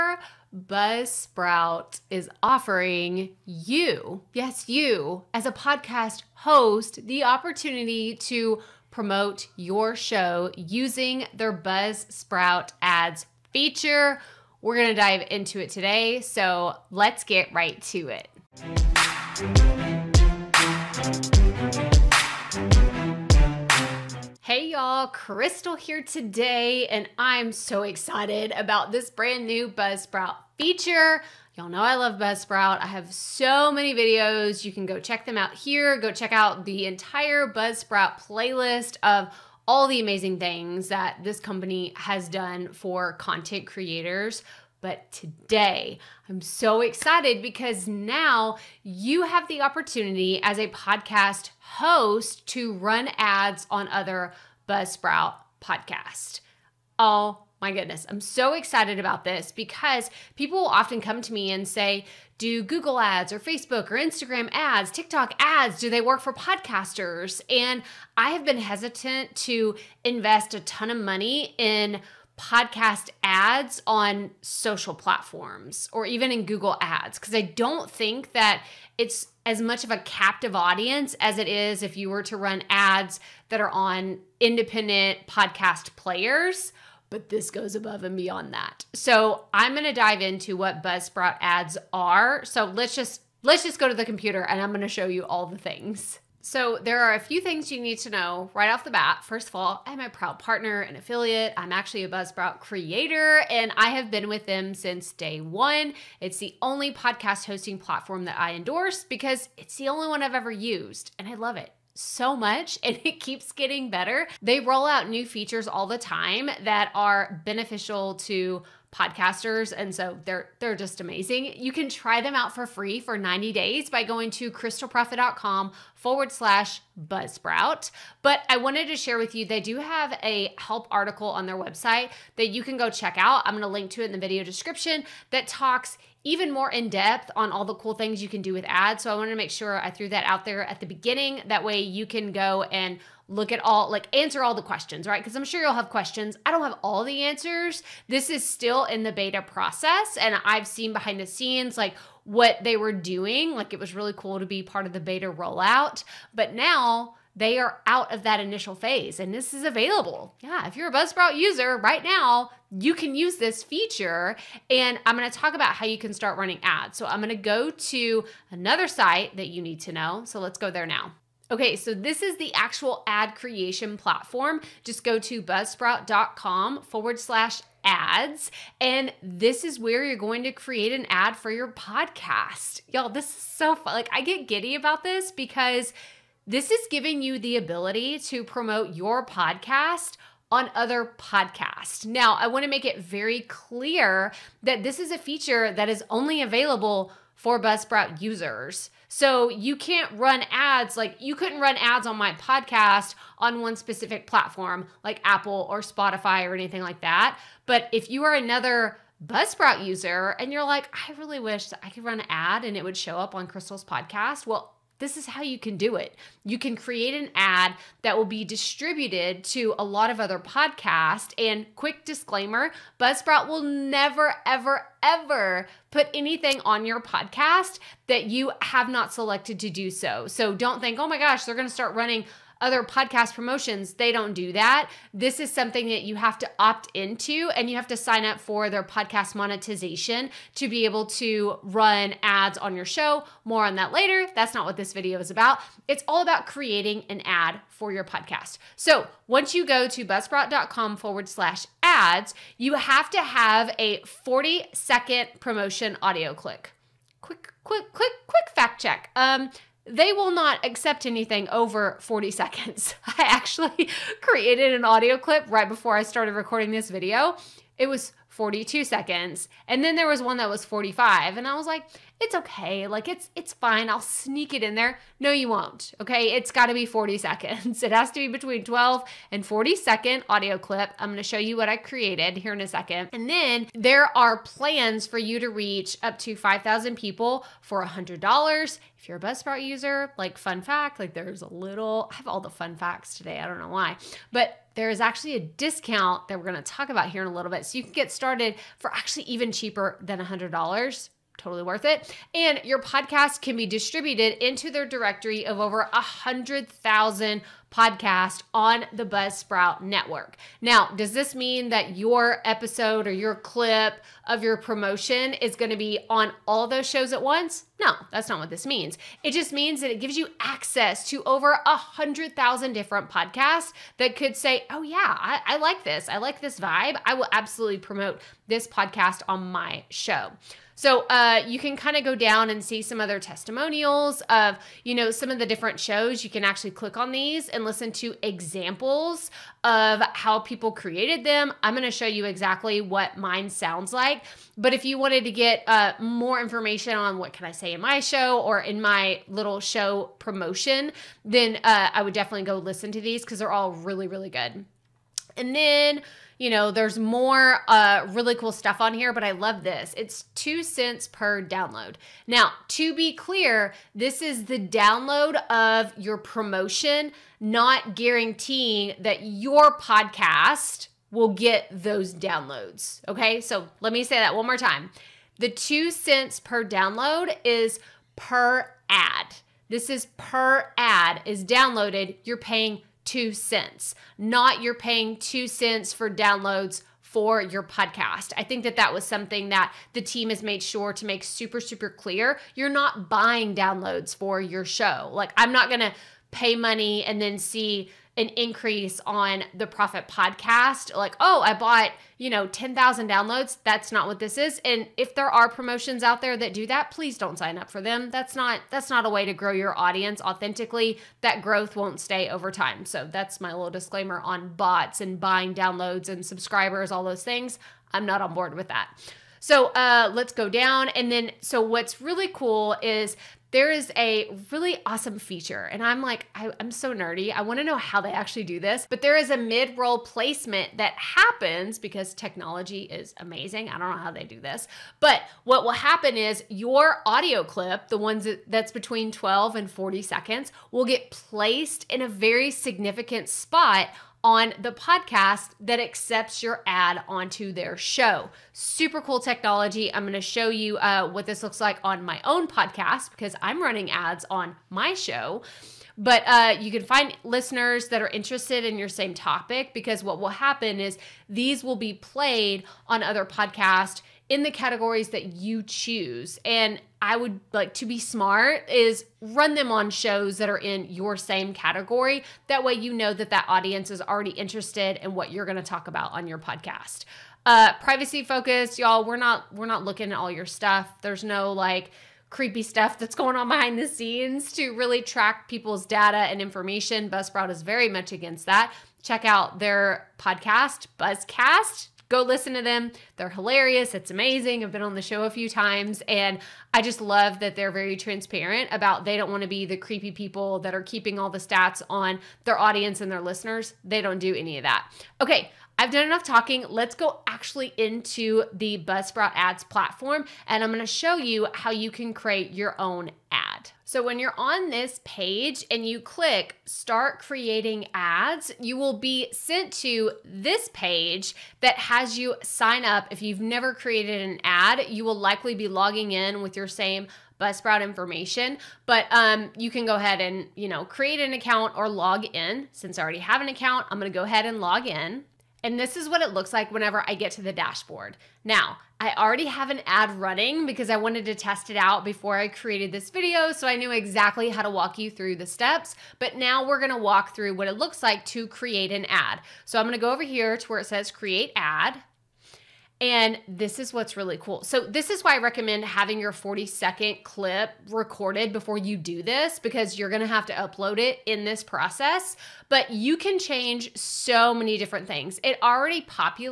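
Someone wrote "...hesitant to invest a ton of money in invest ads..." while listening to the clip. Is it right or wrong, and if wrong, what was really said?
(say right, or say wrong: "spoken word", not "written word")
wrong: "podcast", not "invest".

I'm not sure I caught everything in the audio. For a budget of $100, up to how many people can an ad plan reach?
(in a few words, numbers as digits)
5,000.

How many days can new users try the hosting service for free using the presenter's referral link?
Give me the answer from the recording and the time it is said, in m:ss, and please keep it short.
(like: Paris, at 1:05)
90, at 2:03.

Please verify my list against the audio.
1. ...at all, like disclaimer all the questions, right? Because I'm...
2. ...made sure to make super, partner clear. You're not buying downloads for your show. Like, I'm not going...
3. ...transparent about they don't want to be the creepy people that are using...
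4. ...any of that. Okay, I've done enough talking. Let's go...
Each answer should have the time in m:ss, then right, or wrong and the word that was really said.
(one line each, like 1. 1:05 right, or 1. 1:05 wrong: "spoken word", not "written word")
1. 2:23 wrong: "answer", not "disclaimer"
2. 6:30 wrong: "super", not "partner"
3. 8:17 wrong: "keeping", not "using"
4. 8:24 right.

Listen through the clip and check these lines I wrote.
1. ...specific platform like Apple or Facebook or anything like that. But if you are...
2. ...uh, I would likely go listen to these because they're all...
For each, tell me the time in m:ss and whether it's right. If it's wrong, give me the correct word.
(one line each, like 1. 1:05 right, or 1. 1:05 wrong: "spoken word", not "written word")
1. 3:23 wrong: "Spotify", not "Facebook"
2. 5:51 wrong: "definitely", not "likely".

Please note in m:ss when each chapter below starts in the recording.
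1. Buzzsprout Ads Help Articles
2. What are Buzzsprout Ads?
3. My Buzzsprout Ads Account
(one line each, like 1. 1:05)
1. 1:40
2. 3:05
3. 8:46.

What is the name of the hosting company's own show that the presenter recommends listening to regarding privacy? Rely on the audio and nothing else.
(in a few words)
Buzzcast.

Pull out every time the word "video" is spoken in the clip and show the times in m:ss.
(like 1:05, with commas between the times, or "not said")
0:33, 2:14, 4:04, 4:26, 9:03.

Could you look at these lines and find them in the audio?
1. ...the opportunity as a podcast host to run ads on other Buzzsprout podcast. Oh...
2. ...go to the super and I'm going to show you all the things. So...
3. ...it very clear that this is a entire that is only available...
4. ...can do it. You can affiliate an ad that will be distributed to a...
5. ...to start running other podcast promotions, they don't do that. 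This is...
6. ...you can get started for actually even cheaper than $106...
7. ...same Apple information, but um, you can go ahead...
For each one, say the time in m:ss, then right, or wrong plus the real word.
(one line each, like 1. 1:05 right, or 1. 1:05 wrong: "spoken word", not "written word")
1. 0:49 right
2. 1:33 wrong: "computer", not "super"
3. 3:12 wrong: "feature", not "entire"
4. 3:35 wrong: "create", not "affiliate"
5. 3:51 right
6. 4:57 wrong: "100", not "106"
7. 8:46 wrong: "Buzzsprout", not "Apple".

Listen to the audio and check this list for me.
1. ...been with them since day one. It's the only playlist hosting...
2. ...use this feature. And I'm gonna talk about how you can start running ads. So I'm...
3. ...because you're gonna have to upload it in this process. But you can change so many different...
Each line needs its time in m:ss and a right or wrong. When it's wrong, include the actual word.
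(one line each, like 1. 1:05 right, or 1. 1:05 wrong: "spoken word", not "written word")
1. 1:44 wrong: "podcast", not "playlist"
2. 2:43 right
3. 9:19 right.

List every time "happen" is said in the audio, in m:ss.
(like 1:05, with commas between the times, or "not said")
7:10, 7:15, 7:40.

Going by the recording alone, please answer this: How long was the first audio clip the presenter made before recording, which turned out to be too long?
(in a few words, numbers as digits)
42 seconds.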